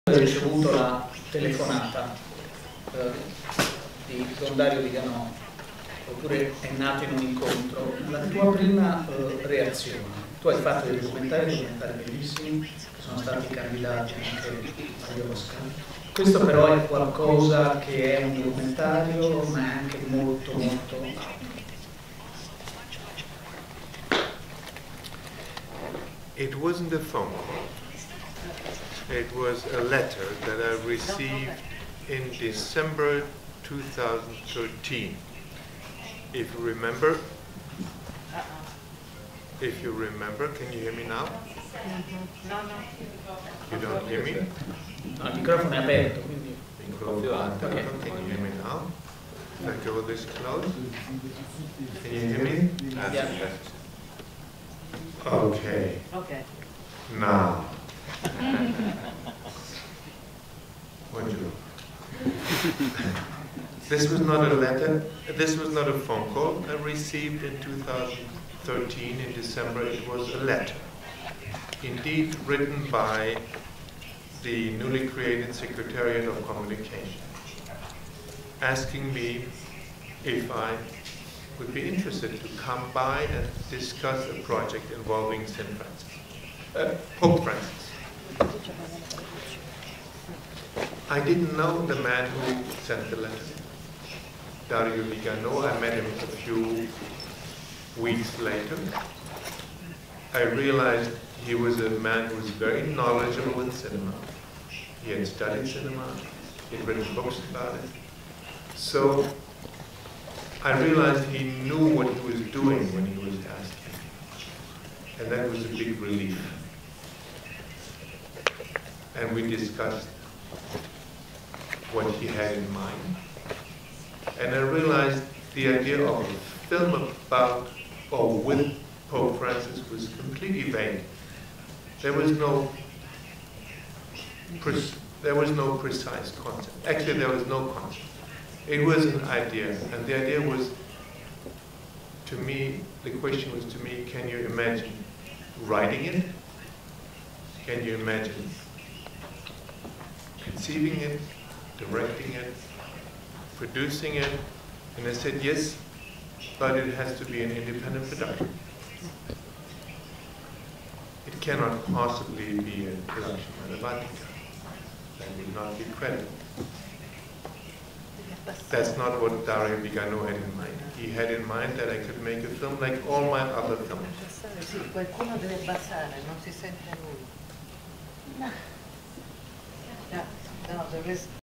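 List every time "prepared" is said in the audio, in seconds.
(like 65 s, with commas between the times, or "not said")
not said.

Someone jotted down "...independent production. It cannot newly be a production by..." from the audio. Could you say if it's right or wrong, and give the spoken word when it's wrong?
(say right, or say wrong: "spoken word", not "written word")
wrong: "possibly", not "newly".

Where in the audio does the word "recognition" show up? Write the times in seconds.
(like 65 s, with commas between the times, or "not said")
not said.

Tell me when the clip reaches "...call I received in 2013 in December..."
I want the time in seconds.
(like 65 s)
66 s.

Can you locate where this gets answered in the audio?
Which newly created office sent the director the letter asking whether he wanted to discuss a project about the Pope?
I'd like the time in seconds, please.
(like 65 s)
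75 s.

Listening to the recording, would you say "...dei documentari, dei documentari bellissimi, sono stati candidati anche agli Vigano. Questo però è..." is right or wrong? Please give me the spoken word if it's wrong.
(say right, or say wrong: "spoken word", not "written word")
wrong: "Oscar", not "Vigano".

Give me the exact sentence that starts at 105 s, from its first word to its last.
He had studied cinema, he had written books about it.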